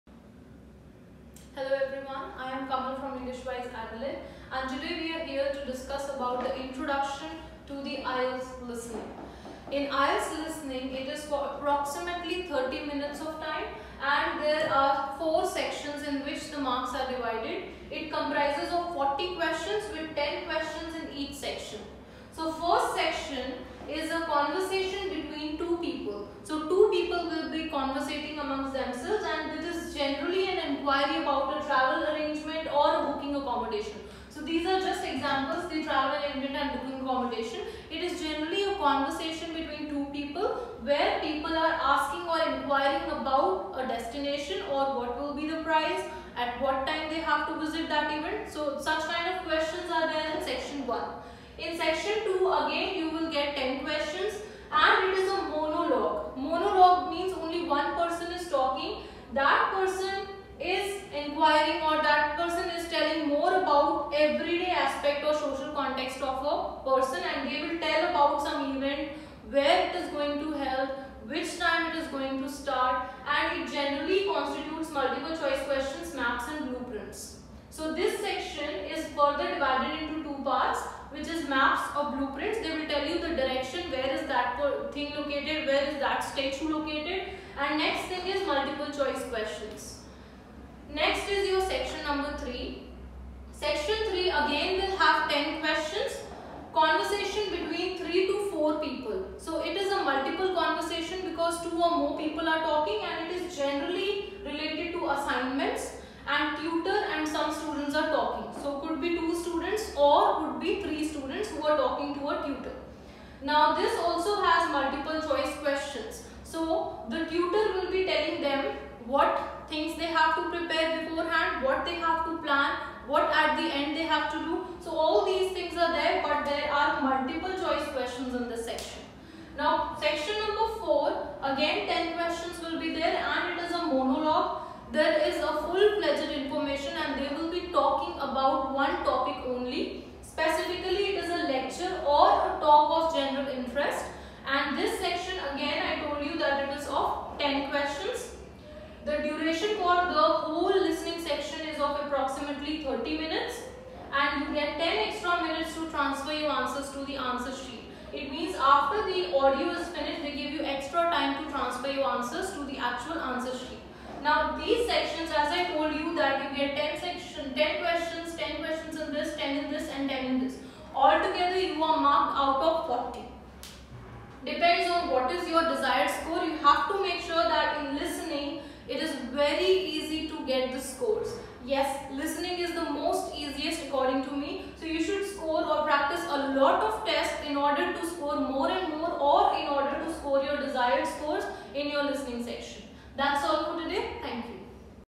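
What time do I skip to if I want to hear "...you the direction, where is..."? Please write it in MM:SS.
01:23.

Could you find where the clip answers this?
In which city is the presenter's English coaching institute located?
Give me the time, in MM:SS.
00:03.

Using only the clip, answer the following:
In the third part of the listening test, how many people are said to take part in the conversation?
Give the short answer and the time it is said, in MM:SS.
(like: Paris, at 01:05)
3 to 4, at 01:37.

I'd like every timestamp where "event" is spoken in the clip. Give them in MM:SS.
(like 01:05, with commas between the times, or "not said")
00:48, 01:08.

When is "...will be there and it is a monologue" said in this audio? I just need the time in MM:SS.
02:12.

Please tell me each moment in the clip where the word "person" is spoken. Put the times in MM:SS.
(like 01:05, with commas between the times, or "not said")
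01:02, 01:06.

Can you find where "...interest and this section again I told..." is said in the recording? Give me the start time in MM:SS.
02:23.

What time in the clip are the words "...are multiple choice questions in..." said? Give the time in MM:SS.
02:06.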